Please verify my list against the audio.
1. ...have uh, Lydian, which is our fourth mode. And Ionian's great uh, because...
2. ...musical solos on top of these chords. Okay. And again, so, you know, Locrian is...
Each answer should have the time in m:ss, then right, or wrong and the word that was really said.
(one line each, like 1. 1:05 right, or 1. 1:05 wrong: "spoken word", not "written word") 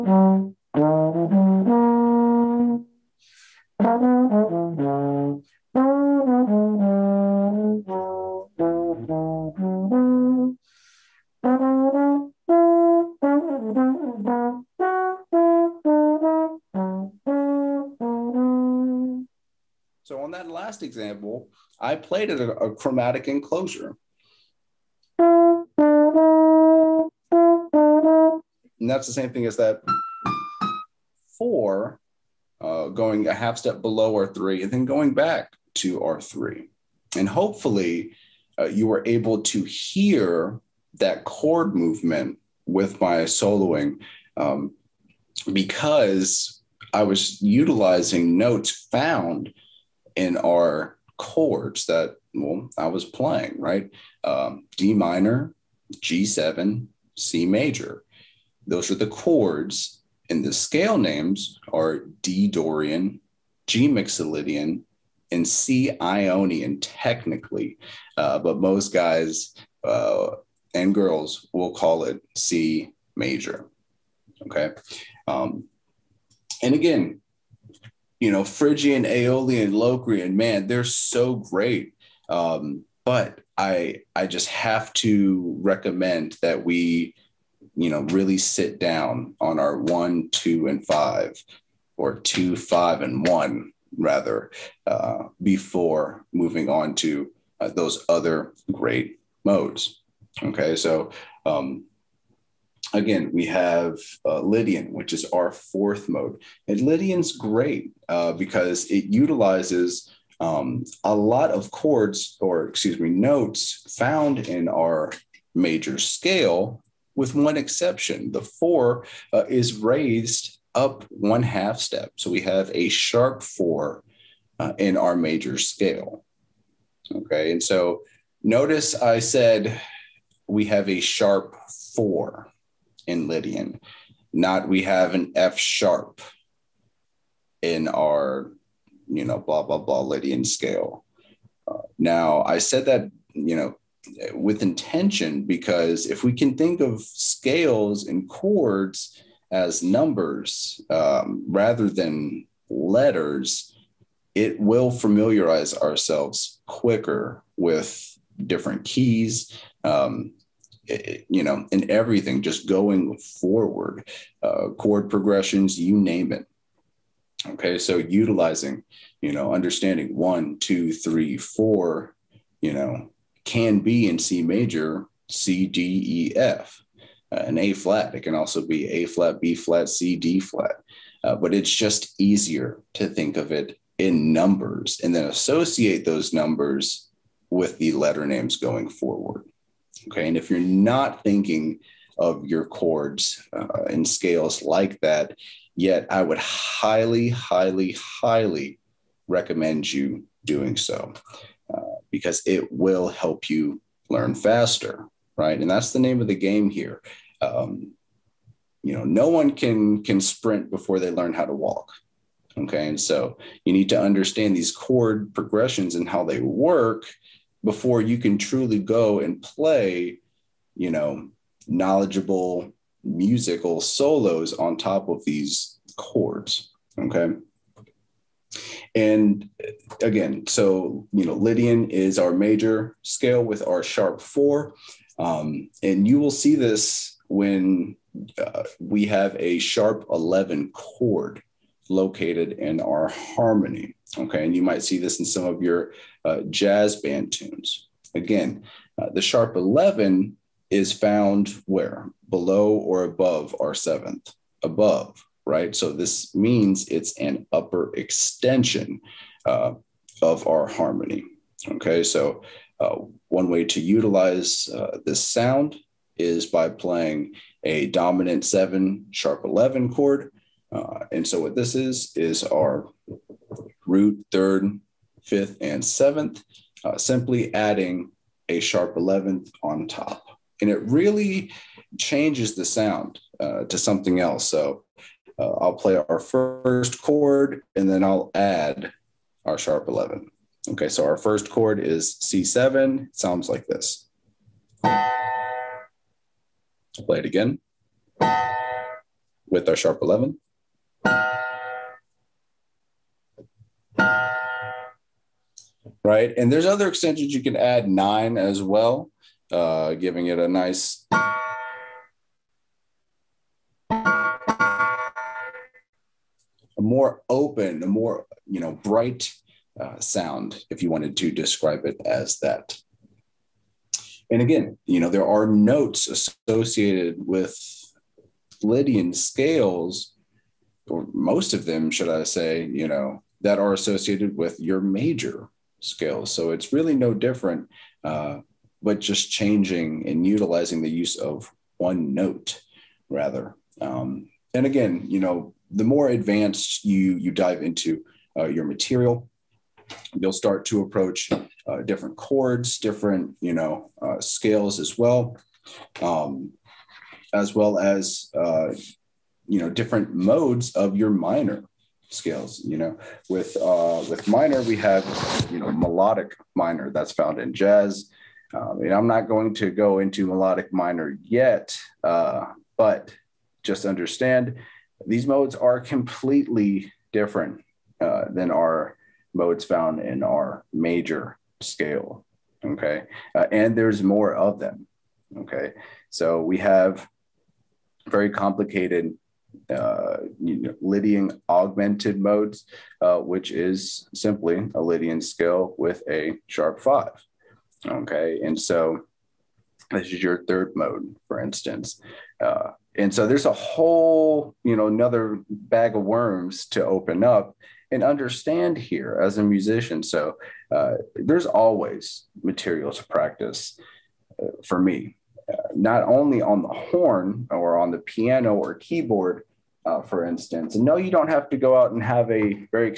1. 1:43 wrong: "Lydian", not "Ionian"
2. 3:43 wrong: "Lydian", not "Locrian".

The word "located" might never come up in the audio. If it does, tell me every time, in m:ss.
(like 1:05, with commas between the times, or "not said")
4:01.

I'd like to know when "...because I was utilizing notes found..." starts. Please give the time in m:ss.
0:45.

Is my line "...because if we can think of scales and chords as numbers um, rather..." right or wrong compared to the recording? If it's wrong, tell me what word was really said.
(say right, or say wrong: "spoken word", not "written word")
right.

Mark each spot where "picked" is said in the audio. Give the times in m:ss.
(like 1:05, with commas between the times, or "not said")
not said.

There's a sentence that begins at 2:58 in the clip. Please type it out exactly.
It can also be A flat, B flat, C, D flat.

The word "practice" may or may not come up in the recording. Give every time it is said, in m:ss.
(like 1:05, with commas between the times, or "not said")
6:53.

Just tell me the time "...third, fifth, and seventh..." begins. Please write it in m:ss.
4:34.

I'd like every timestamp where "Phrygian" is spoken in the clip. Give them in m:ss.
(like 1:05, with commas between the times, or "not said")
1:18.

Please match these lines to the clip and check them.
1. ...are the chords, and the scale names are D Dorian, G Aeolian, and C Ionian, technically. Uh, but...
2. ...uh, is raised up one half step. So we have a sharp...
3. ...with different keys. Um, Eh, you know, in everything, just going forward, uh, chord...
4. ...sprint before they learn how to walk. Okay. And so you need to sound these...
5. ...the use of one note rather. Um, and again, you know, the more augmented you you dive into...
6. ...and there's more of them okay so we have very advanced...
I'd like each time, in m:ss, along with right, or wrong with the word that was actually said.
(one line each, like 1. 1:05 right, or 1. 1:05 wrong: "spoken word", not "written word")
1. 0:58 wrong: "Mixolydian", not "Aeolian"
2. 1:59 right
3. 2:37 right
4. 3:30 wrong: "understand", not "sound"
5. 5:40 wrong: "advanced", not "augmented"
6. 6:23 wrong: "complicated", not "advanced".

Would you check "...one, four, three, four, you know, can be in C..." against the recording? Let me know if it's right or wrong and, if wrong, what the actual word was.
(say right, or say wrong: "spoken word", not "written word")
wrong: "two", not "four".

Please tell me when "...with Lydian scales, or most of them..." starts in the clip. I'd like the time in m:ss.
5:27.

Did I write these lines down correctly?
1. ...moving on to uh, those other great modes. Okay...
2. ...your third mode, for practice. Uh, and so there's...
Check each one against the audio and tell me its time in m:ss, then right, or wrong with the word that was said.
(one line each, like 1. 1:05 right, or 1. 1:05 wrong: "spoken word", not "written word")
1. 1:36 right
2. 6:40 wrong: "instance", not "practice".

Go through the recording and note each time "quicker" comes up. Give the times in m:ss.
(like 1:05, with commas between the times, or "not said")
2:36.